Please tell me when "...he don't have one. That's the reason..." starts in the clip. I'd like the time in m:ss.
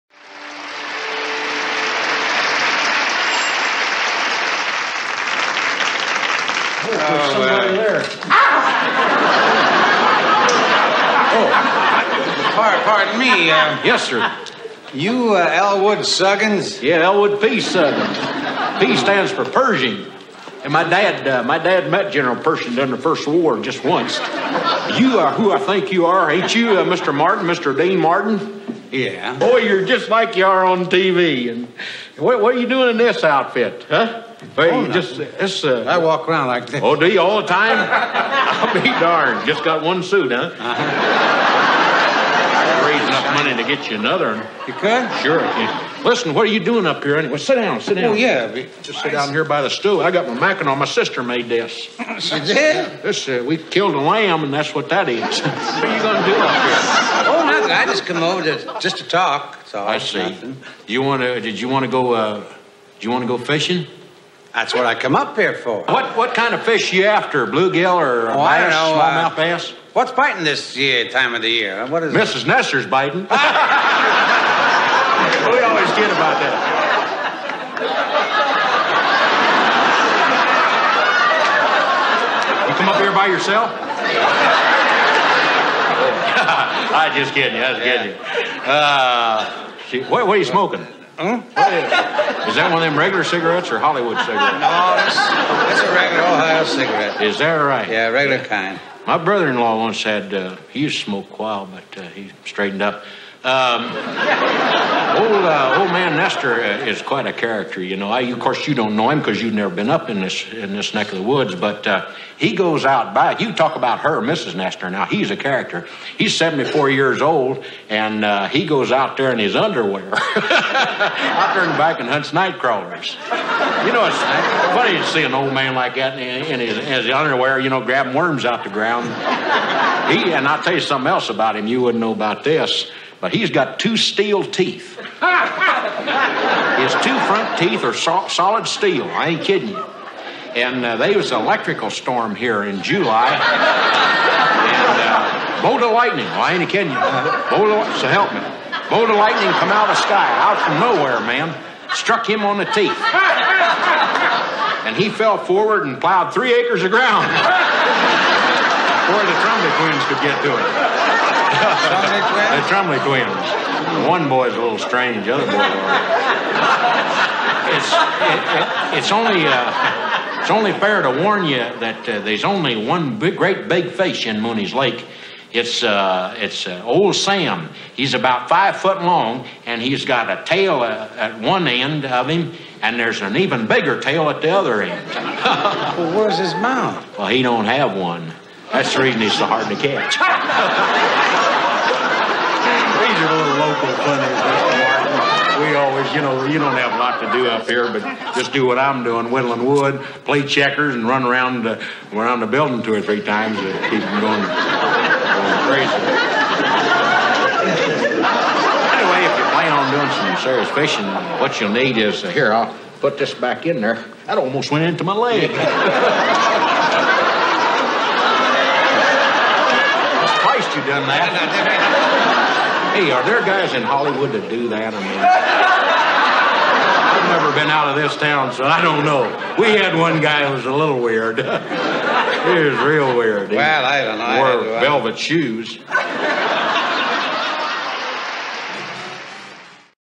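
3:07.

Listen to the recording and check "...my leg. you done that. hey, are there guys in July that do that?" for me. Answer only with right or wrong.
wrong.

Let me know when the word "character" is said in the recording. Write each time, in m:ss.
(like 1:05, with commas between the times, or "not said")
1:47, 1:55.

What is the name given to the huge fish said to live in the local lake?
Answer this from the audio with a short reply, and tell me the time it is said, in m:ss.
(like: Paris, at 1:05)
Sam, at 2:56.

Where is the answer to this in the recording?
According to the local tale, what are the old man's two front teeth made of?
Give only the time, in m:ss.
2:18.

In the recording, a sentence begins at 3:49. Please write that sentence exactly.
We had one guy who was a little weird.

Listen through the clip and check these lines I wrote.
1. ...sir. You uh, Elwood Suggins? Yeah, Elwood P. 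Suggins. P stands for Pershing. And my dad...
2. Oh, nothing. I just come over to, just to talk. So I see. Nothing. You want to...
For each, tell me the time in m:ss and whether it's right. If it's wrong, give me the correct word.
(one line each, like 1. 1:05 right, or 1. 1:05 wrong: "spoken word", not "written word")
1. 0:14 right
2. 0:57 right.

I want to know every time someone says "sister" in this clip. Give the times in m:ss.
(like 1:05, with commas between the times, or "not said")
0:50.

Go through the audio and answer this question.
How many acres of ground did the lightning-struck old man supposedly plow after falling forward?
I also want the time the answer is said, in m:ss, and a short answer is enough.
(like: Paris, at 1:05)
3, at 2:36.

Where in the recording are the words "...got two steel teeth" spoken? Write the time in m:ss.
2:13.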